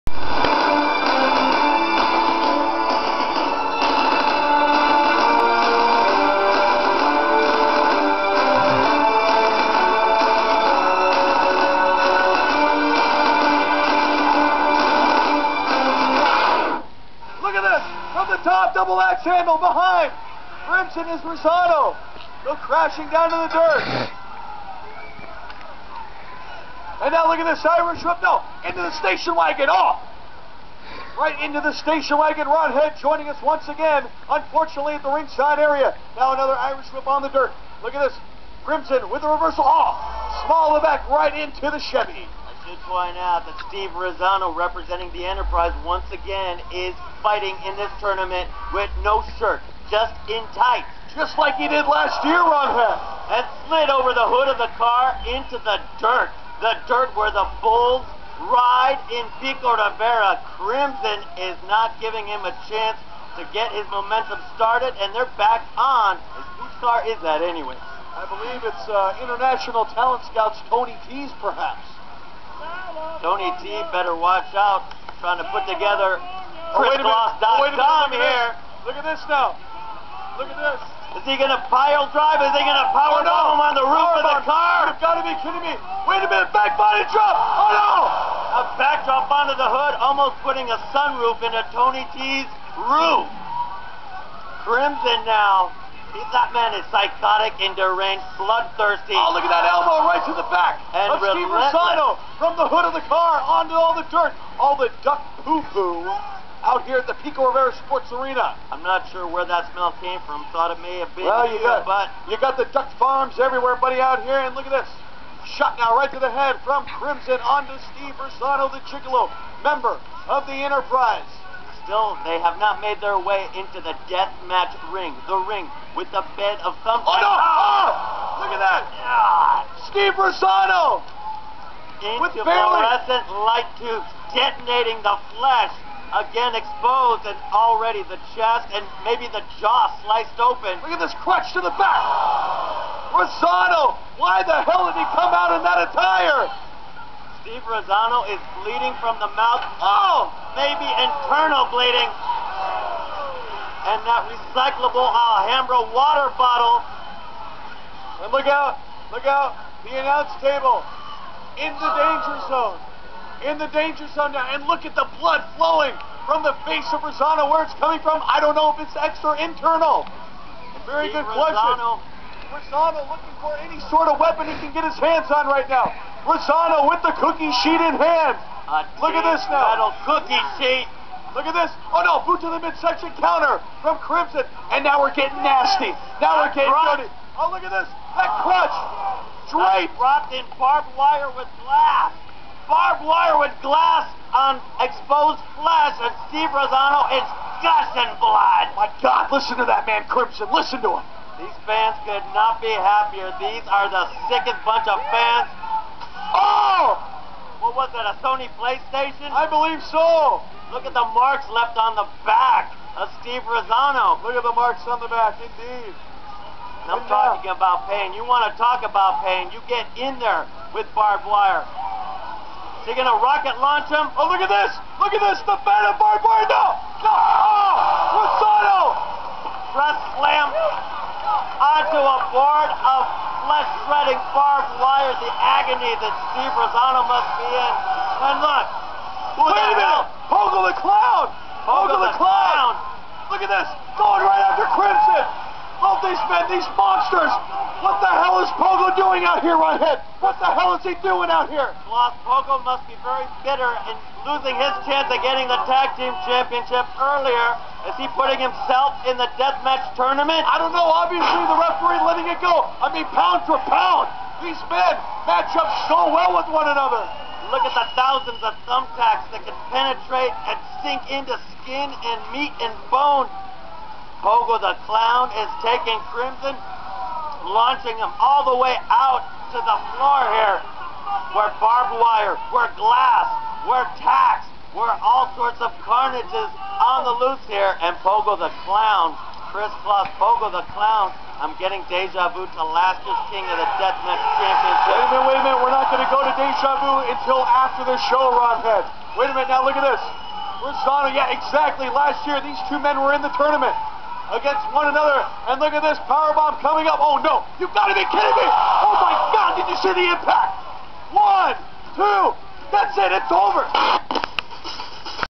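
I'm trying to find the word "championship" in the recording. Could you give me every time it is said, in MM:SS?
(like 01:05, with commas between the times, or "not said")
04:16, 04:54.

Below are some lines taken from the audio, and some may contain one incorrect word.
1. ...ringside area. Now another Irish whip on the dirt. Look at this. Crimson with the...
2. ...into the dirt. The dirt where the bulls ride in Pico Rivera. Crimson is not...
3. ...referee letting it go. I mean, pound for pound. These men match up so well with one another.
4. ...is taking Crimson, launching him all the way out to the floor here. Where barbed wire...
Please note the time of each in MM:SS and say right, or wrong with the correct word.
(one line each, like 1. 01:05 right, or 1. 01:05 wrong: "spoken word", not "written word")
1. 00:35 right
2. 00:55 right
3. 04:21 right
4. 04:35 right.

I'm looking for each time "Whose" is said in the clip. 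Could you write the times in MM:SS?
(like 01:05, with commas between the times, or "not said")
01:06.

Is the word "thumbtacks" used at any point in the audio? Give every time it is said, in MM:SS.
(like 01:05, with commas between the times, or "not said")
02:06, 04:28.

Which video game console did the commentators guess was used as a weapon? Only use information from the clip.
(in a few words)
Sony PlayStation.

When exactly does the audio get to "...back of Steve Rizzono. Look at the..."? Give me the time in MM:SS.
03:32.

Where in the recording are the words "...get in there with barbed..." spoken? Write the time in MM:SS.
03:39.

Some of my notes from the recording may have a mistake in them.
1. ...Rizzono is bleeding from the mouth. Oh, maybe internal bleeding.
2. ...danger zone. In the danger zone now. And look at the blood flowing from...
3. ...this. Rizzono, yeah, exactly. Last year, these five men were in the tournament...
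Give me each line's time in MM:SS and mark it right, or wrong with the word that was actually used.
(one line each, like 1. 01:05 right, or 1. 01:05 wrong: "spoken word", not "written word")
1. 02:27 right
2. 02:41 right
3. 04:59 wrong: "two", not "five".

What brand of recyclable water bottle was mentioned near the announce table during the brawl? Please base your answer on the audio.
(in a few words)
Alhambra.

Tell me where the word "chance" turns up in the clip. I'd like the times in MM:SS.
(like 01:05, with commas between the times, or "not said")
01:02, 04:14.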